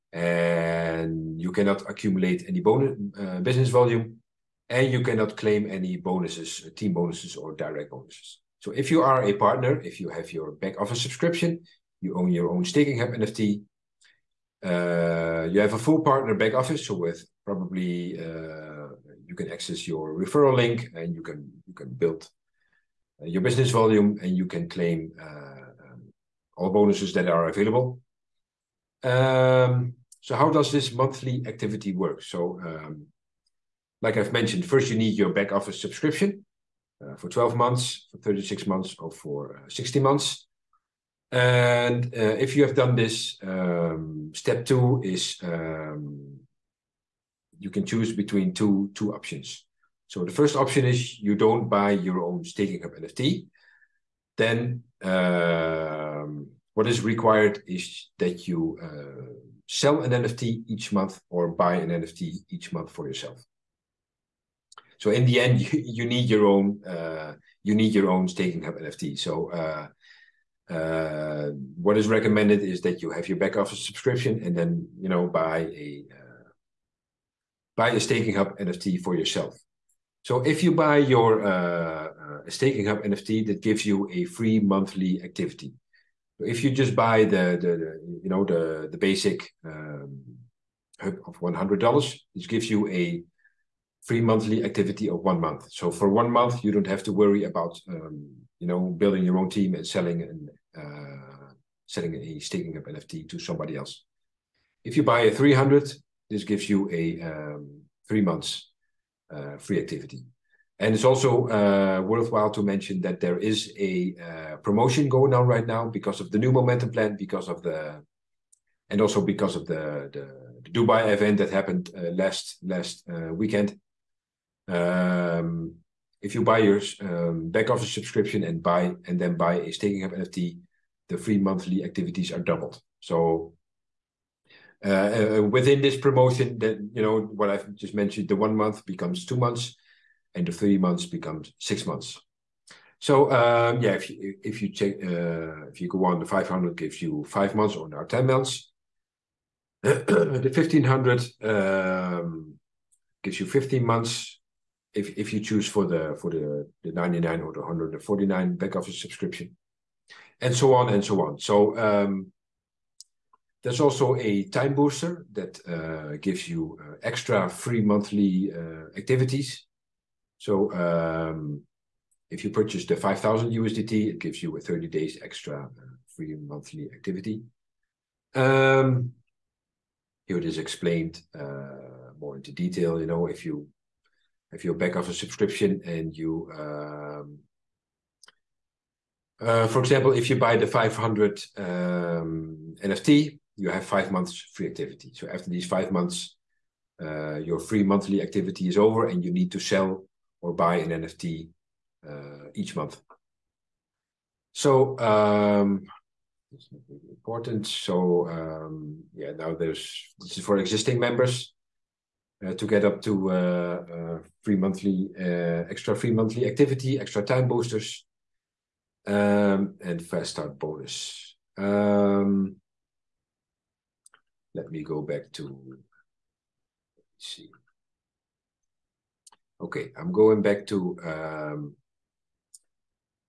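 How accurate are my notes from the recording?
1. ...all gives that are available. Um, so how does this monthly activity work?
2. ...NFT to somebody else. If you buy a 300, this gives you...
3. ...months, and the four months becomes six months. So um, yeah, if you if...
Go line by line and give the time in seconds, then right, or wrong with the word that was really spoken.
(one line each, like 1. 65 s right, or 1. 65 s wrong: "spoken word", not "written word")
1. 26 s wrong: "bonuses", not "gives"
2. 102 s right
3. 139 s wrong: "three", not "four".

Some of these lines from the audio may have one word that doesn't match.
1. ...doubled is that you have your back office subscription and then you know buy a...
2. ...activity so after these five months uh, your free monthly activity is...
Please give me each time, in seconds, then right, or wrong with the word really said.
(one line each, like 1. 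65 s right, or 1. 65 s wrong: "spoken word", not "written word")
1. 72 s wrong: "recommended", not "doubled"
2. 194 s right.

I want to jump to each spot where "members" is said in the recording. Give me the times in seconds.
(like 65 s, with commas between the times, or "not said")
210 s.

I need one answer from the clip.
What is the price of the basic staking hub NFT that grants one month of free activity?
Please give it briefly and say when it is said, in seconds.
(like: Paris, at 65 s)
$100, at 91 s.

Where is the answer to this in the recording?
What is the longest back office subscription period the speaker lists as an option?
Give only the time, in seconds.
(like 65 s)
39 s.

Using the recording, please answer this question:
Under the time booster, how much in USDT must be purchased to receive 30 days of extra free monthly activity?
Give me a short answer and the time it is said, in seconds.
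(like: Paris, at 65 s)
5000 USDT, at 172 s.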